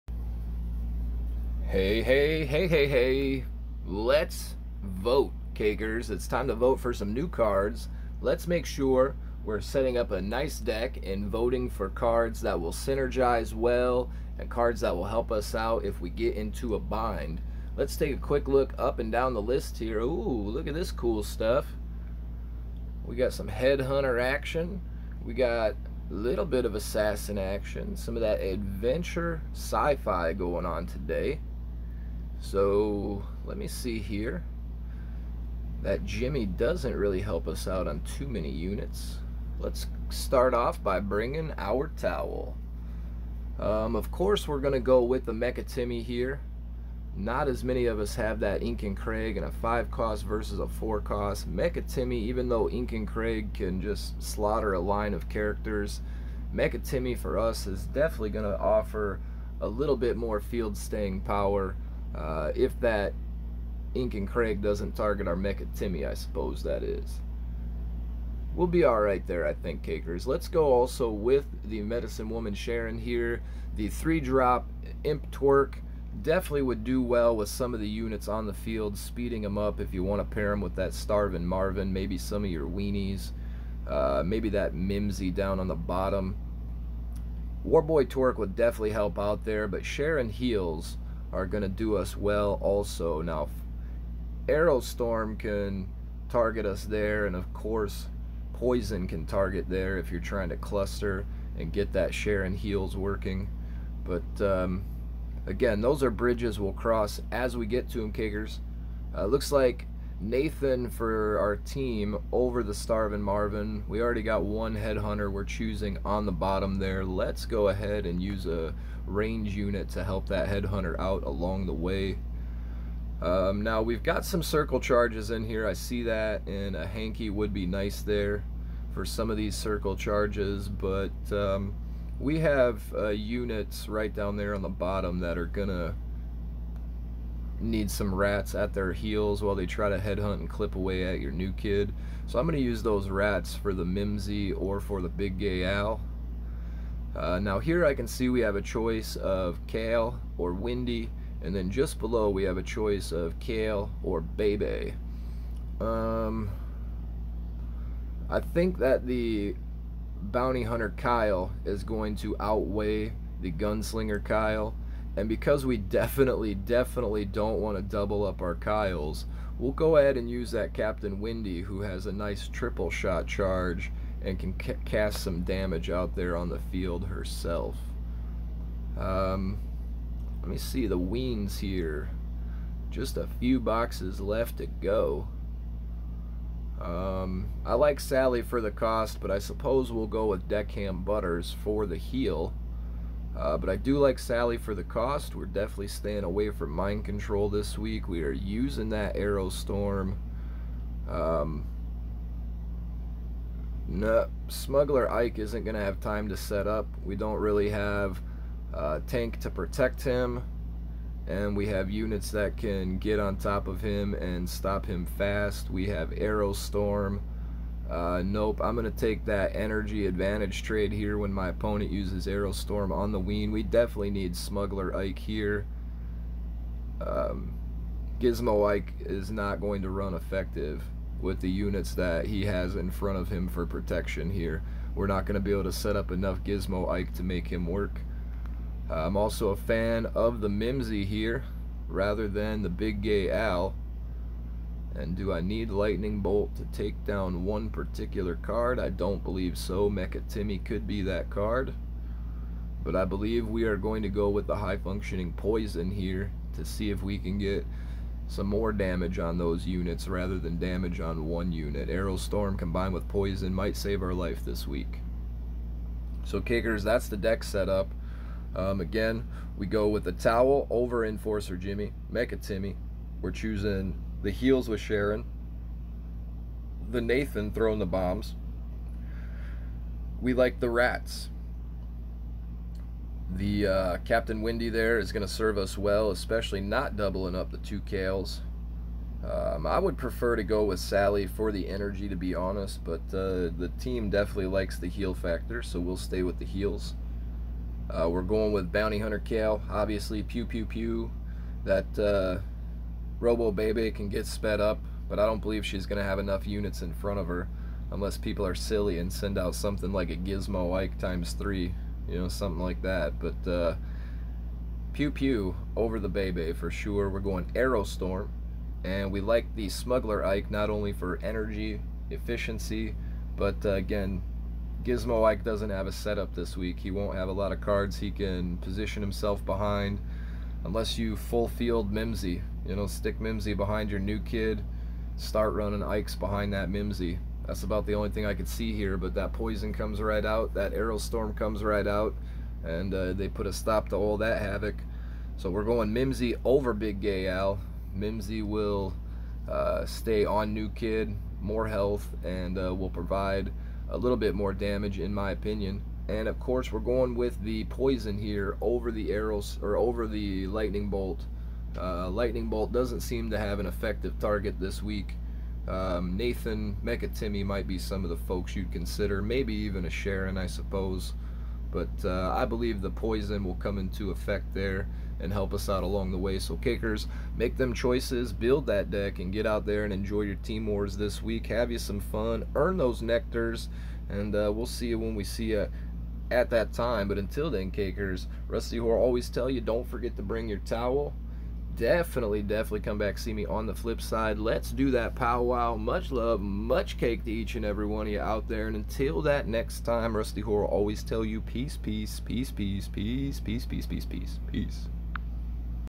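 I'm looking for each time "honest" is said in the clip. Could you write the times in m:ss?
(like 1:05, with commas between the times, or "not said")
4:52.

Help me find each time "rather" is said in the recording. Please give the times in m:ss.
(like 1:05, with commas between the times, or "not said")
4:01, 4:20.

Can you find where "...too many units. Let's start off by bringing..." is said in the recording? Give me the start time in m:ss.
0:38.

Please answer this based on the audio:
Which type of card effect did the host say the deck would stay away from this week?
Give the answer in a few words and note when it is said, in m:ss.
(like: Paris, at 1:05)
mind control, at 3:16.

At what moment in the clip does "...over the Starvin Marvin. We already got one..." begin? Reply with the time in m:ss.
1:52.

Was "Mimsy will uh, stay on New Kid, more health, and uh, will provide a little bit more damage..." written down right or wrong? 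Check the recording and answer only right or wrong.
right.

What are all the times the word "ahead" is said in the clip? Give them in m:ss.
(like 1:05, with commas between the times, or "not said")
1:57, 2:49.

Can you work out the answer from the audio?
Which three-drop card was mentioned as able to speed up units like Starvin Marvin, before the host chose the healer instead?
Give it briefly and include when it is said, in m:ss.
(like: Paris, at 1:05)
Imp Tweek, at 1:15.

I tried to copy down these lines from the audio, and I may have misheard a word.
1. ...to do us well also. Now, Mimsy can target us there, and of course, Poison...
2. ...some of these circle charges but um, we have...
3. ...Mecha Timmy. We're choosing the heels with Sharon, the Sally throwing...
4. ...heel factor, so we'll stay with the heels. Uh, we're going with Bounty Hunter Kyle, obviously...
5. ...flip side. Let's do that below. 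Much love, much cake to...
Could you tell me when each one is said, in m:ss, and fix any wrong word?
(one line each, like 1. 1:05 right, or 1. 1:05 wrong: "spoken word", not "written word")
1. 1:31 wrong: "Arrowstorm", not "Mimsy"
2. 2:09 right
3. 4:32 wrong: "Nathan", not "Sally"
4. 4:54 right
5. 6:33 wrong: "powwow", not "below".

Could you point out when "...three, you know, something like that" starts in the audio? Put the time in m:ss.
5:11.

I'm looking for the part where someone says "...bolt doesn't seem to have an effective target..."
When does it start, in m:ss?
6:02.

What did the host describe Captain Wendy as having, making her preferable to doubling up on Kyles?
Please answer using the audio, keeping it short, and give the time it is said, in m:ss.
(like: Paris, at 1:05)
triple shot charge, at 2:52.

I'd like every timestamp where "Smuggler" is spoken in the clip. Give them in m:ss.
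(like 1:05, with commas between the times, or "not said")
3:24, 3:44, 5:19.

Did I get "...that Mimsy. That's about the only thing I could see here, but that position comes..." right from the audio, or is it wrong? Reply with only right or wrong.
wrong.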